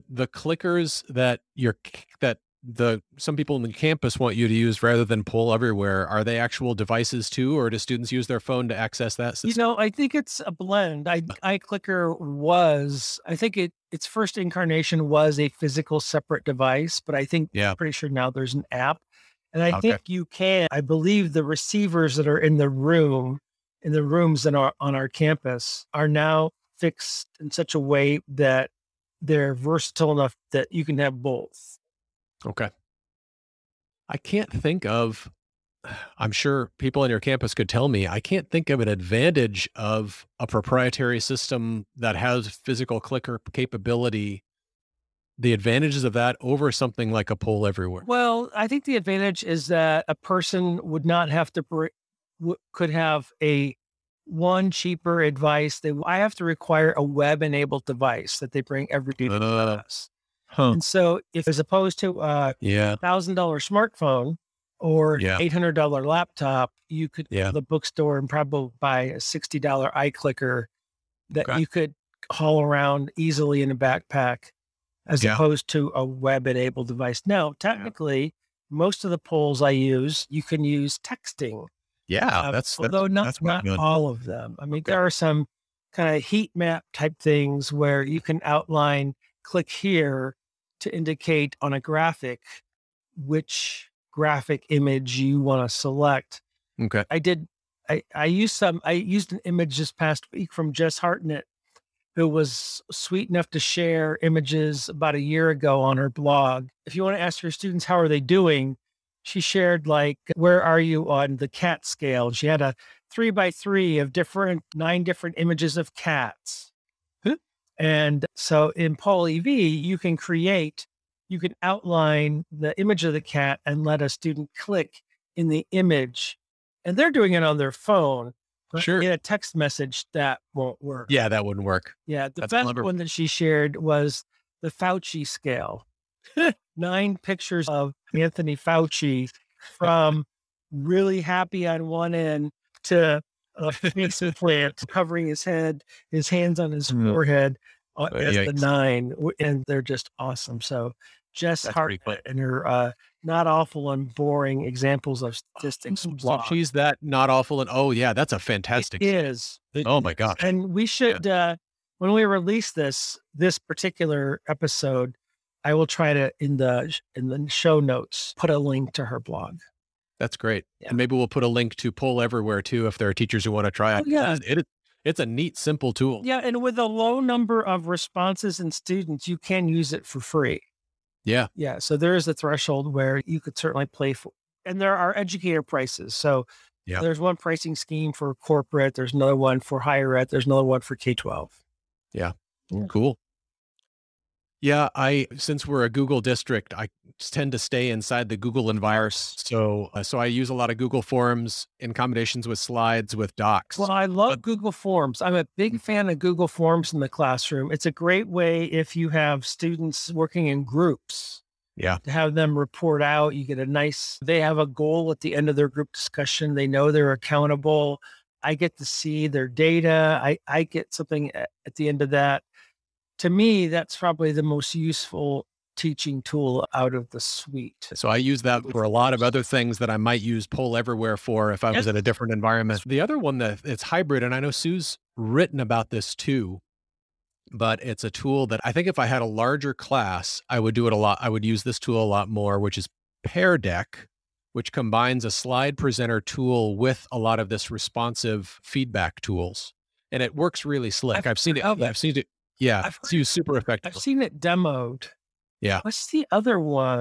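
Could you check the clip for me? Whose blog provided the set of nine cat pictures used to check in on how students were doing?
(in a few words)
Jess Hartnett.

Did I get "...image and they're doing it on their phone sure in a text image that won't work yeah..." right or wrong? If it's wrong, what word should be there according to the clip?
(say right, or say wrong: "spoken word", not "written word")
wrong: "message", not "image".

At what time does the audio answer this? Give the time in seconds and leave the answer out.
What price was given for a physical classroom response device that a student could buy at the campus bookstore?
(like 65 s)
69 s.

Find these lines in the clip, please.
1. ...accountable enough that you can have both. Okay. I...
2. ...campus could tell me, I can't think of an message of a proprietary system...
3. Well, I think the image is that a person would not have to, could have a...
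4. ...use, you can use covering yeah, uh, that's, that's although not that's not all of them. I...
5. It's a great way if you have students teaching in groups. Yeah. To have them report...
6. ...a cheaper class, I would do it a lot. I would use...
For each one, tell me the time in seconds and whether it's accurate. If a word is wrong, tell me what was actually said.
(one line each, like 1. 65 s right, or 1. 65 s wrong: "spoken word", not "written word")
1. 29 s wrong: "versatile", not "accountable"
2. 37 s wrong: "advantage", not "message"
3. 48 s wrong: "advantage", not "image"
4. 79 s wrong: "texting", not "covering"
5. 207 s wrong: "working", not "teaching"
6. 239 s wrong: "larger", not "cheaper".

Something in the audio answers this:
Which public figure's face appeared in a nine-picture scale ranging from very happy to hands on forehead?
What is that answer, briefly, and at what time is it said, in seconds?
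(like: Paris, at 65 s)
Anthony Fauci, at 138 s.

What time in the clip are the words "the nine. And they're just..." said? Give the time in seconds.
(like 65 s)
148 s.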